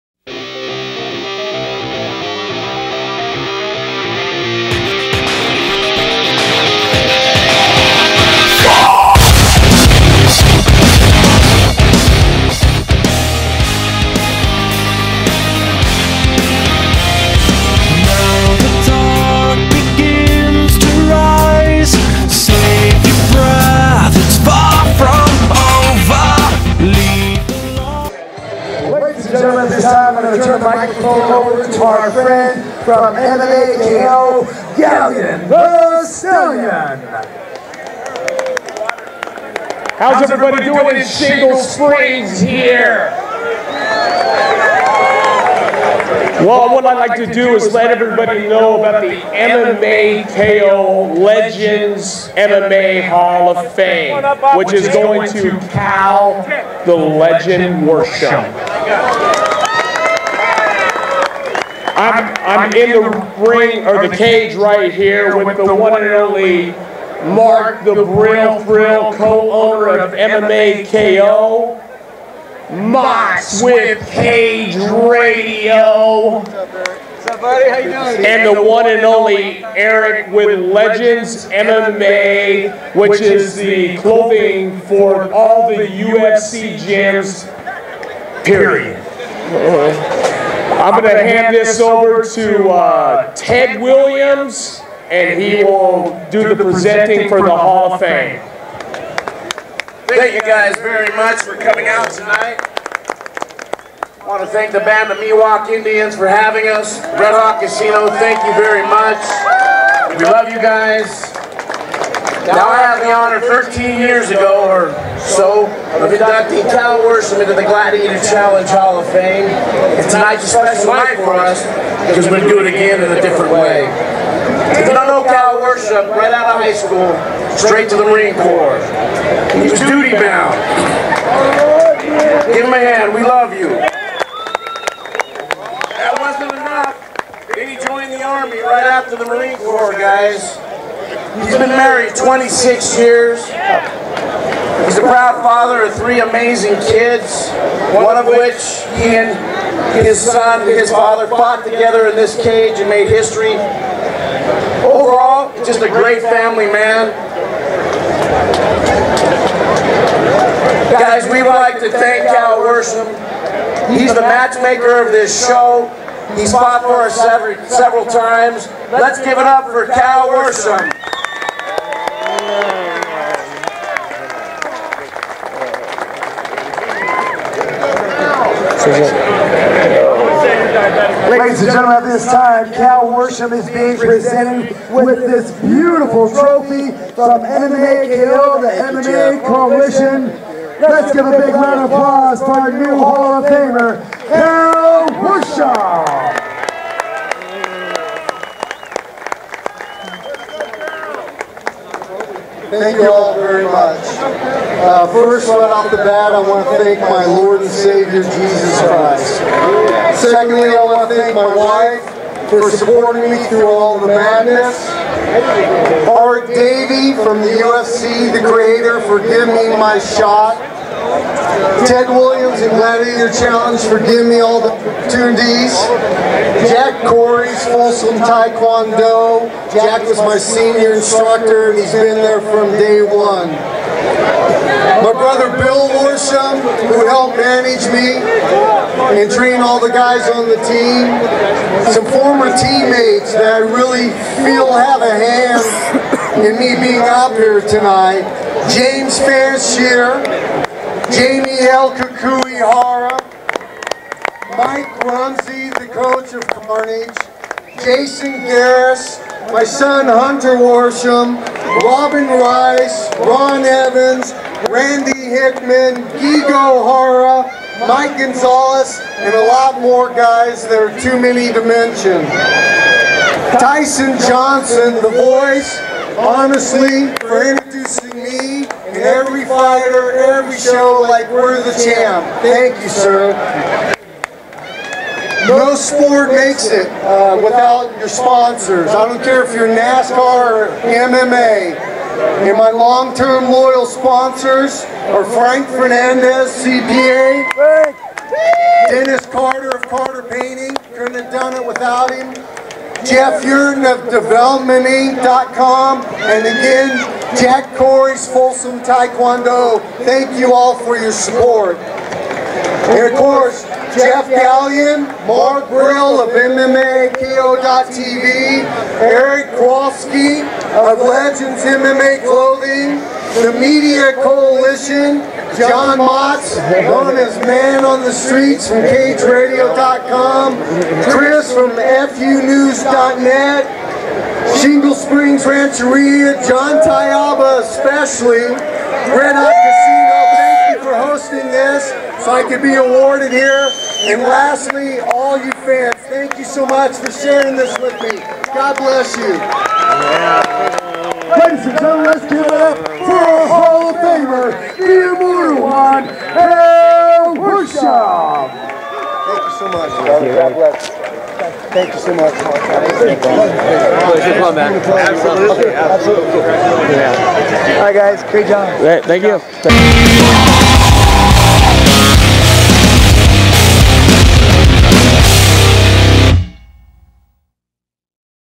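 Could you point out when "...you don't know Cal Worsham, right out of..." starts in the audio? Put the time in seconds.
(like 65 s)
124 s.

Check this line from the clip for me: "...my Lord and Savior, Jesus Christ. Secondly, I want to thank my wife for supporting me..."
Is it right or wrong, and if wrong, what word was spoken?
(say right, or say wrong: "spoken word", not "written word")
right.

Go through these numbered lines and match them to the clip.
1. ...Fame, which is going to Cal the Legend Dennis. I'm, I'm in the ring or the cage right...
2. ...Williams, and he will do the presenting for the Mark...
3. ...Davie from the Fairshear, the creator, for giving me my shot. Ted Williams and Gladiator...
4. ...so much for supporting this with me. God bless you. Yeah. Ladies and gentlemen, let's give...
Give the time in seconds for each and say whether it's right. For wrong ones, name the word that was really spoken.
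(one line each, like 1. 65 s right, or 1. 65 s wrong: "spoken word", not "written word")
1. 53 s wrong: "Worsham", not "Dennis"
2. 93 s wrong: "Hall", not "Mark"
3. 216 s wrong: "UFC", not "Fairshear"
4. 346 s wrong: "sharing", not "supporting".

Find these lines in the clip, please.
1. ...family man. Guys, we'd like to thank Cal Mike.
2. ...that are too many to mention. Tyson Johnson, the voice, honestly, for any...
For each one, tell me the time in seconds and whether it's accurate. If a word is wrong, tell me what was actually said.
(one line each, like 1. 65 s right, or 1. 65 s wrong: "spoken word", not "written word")
1. 156 s wrong: "Worsham", not "Mike"
2. 270 s right.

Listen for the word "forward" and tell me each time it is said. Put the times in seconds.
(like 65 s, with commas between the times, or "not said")
not said.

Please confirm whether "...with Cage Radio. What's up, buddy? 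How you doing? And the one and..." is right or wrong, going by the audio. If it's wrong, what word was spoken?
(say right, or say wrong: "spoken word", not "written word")
right.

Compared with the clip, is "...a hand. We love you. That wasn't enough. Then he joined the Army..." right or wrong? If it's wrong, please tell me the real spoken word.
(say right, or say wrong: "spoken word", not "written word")
right.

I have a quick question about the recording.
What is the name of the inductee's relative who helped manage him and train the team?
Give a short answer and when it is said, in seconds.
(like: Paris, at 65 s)
Bill Worsham, at 235 s.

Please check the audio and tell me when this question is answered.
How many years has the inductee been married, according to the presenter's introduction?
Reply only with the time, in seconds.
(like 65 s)
141 s.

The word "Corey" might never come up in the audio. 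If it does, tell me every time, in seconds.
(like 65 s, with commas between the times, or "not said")
227 s, 307 s.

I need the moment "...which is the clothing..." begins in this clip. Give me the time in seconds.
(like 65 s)
82 s.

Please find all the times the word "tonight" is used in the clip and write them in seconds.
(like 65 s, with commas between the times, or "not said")
102 s, 120 s, 247 s.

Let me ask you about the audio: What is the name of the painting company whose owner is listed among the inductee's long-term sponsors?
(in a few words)
Carter Painting.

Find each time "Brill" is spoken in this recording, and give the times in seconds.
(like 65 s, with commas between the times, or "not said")
67 s.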